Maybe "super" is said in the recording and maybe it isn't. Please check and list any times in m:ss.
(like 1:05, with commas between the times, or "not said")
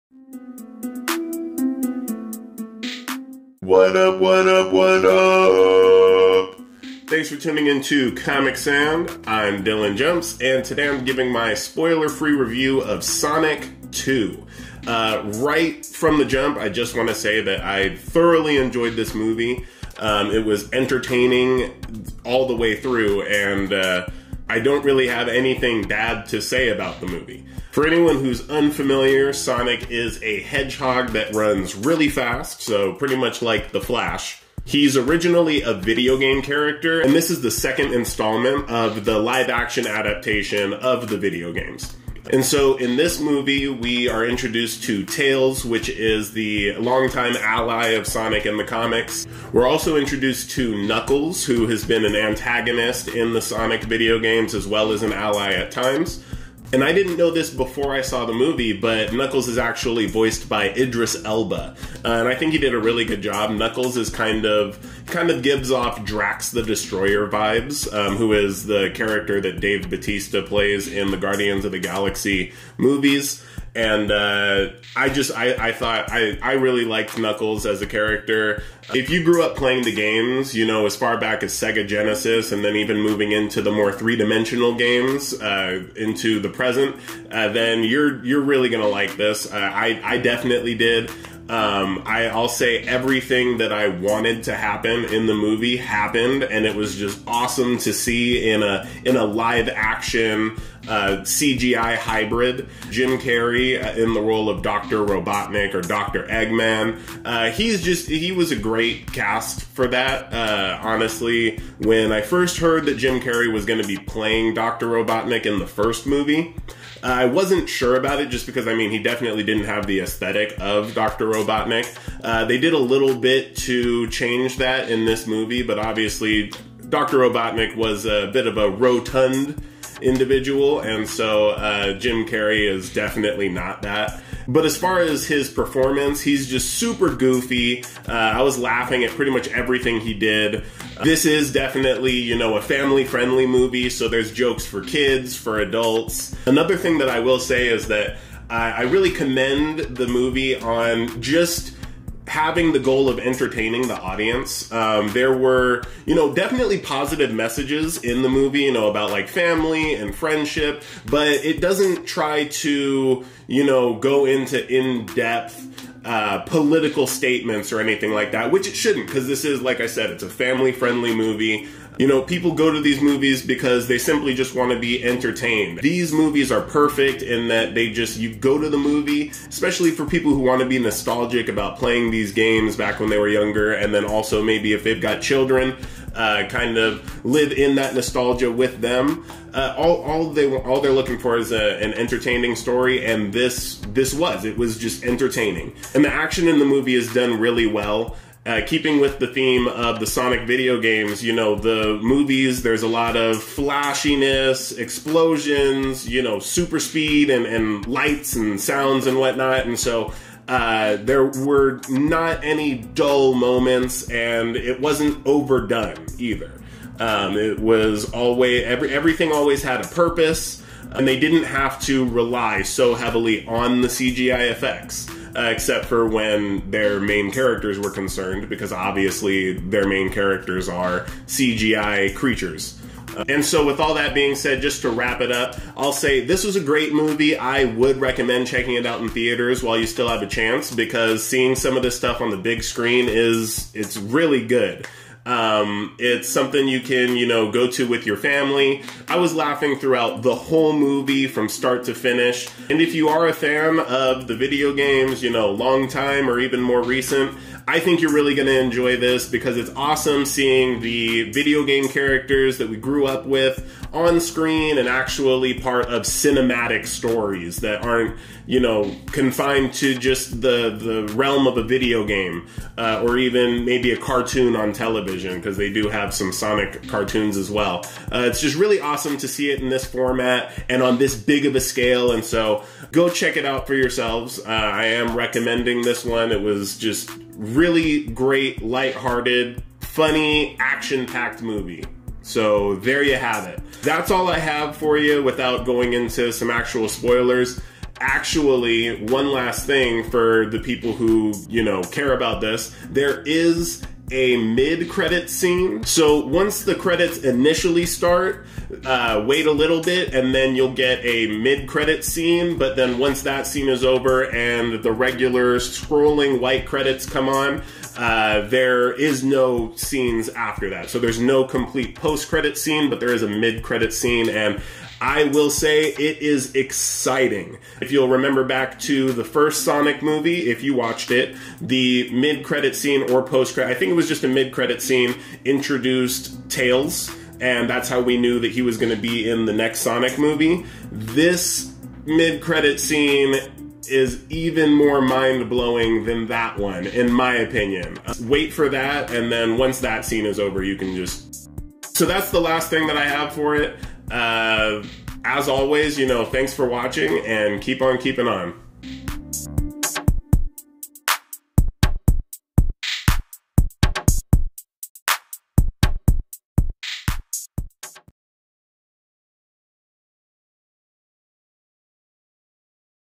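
2:16, 3:26.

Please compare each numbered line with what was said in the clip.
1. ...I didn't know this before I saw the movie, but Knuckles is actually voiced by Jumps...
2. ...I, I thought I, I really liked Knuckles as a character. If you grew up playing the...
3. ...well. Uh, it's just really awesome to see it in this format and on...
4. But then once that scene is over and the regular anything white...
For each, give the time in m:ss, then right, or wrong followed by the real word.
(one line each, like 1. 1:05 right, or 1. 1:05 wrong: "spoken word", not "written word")
1. 0:56 wrong: "Idris", not "Jumps"
2. 1:15 right
3. 4:37 right
4. 5:12 wrong: "scrolling", not "anything".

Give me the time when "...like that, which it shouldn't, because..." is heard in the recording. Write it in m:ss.
2:48.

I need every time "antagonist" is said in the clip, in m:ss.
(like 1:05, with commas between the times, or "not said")
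0:52.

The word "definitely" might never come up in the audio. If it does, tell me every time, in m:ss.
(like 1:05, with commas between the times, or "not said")
1:30, 1:58, 2:12, 2:21, 2:36.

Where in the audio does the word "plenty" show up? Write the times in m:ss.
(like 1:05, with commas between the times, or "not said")
not said.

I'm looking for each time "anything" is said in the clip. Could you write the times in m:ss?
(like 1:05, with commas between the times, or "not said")
0:25, 2:47.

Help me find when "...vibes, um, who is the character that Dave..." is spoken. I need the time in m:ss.
1:07.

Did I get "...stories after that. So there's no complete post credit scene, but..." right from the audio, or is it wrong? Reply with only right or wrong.
wrong.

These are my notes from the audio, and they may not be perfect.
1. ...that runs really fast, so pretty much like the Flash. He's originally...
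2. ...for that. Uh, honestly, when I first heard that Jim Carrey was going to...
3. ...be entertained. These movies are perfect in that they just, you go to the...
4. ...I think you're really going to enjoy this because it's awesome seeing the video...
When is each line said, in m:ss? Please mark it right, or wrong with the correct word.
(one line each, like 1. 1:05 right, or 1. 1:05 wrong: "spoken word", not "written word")
1. 0:31 right
2. 1:49 right
3. 2:54 right
4. 4:17 right.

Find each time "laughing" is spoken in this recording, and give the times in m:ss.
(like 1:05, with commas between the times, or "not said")
2:18, 4:09.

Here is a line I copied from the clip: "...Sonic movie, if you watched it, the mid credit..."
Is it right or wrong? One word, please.
right.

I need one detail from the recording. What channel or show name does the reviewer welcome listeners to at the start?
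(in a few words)
Comic Sand.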